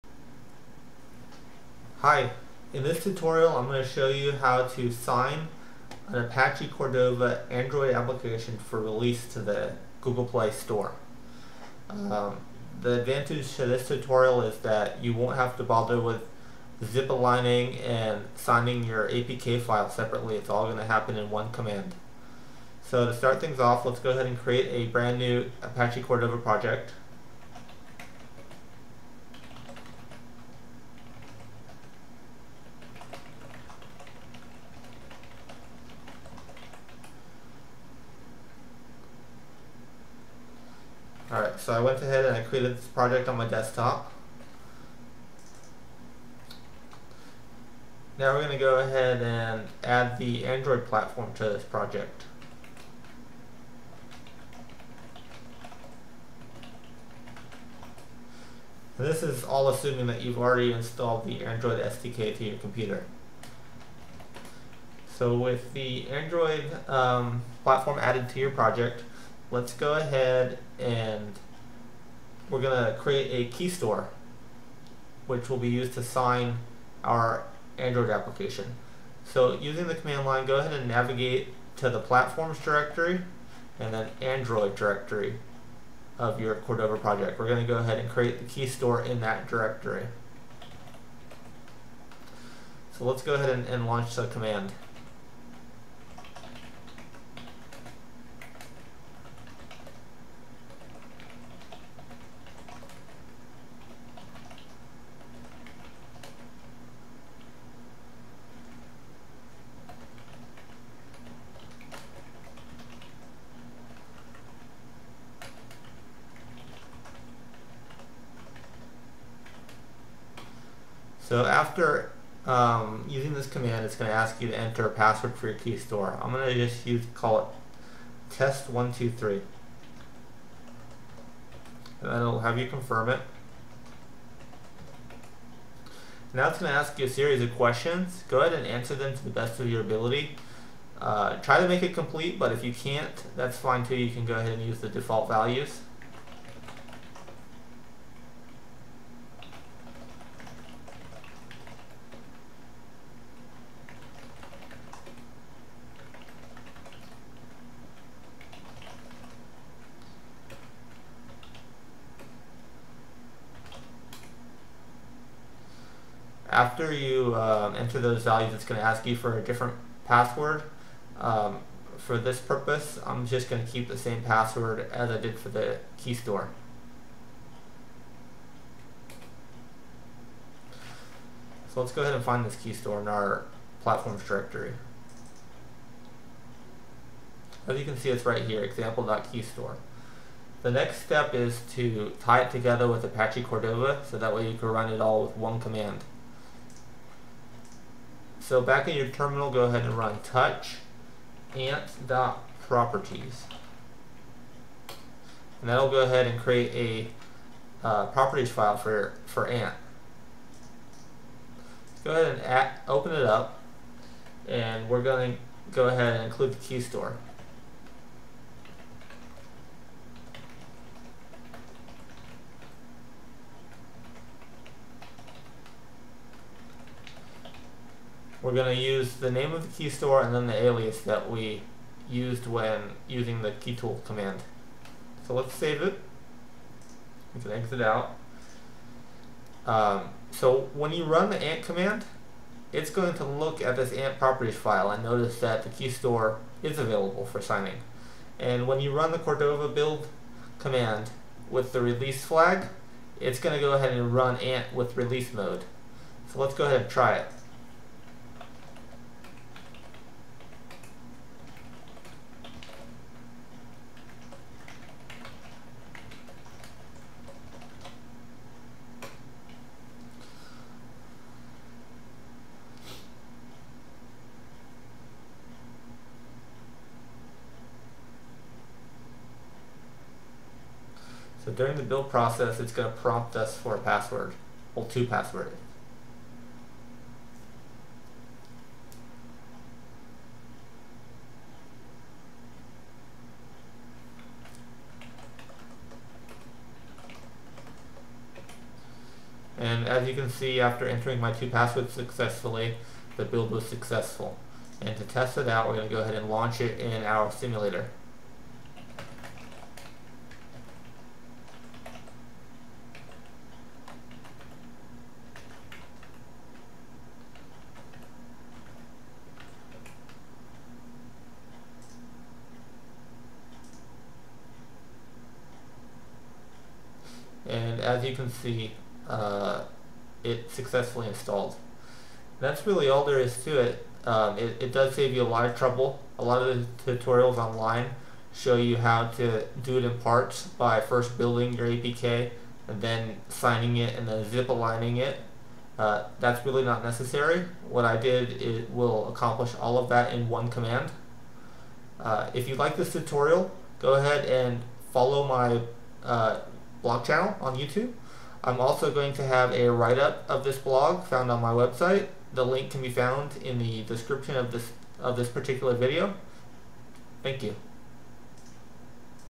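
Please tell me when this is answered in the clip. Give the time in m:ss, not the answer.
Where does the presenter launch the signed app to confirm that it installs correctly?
5:07.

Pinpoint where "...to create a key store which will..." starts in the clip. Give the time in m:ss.
1:12.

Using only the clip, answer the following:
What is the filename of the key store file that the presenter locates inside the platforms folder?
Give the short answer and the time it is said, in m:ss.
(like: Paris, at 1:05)
example.keystore, at 3:08.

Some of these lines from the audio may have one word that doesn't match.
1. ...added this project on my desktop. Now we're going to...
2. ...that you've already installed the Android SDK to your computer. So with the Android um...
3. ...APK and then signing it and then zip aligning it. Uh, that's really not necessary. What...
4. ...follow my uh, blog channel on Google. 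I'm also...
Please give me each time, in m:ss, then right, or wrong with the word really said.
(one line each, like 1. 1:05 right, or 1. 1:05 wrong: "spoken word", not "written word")
1. 0:42 wrong: "created", not "added"
2. 1:00 right
3. 5:41 right
4. 5:54 wrong: "YouTube", not "Google".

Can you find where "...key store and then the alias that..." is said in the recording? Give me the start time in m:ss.
3:49.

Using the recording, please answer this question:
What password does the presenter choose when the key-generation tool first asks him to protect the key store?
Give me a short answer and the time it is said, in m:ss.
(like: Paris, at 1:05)
test123, at 2:08.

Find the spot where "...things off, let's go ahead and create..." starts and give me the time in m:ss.
0:23.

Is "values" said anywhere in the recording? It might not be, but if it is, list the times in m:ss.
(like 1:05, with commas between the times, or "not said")
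2:25, 2:48.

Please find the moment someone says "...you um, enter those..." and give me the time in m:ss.
2:46.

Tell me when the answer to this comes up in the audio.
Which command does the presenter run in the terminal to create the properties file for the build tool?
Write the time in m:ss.
3:20.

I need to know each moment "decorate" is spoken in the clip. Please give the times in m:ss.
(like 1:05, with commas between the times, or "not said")
not said.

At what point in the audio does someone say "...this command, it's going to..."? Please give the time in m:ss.
2:03.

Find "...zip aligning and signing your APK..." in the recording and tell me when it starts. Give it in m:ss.
0:16.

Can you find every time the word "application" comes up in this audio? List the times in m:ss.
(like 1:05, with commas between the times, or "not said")
0:07, 1:18.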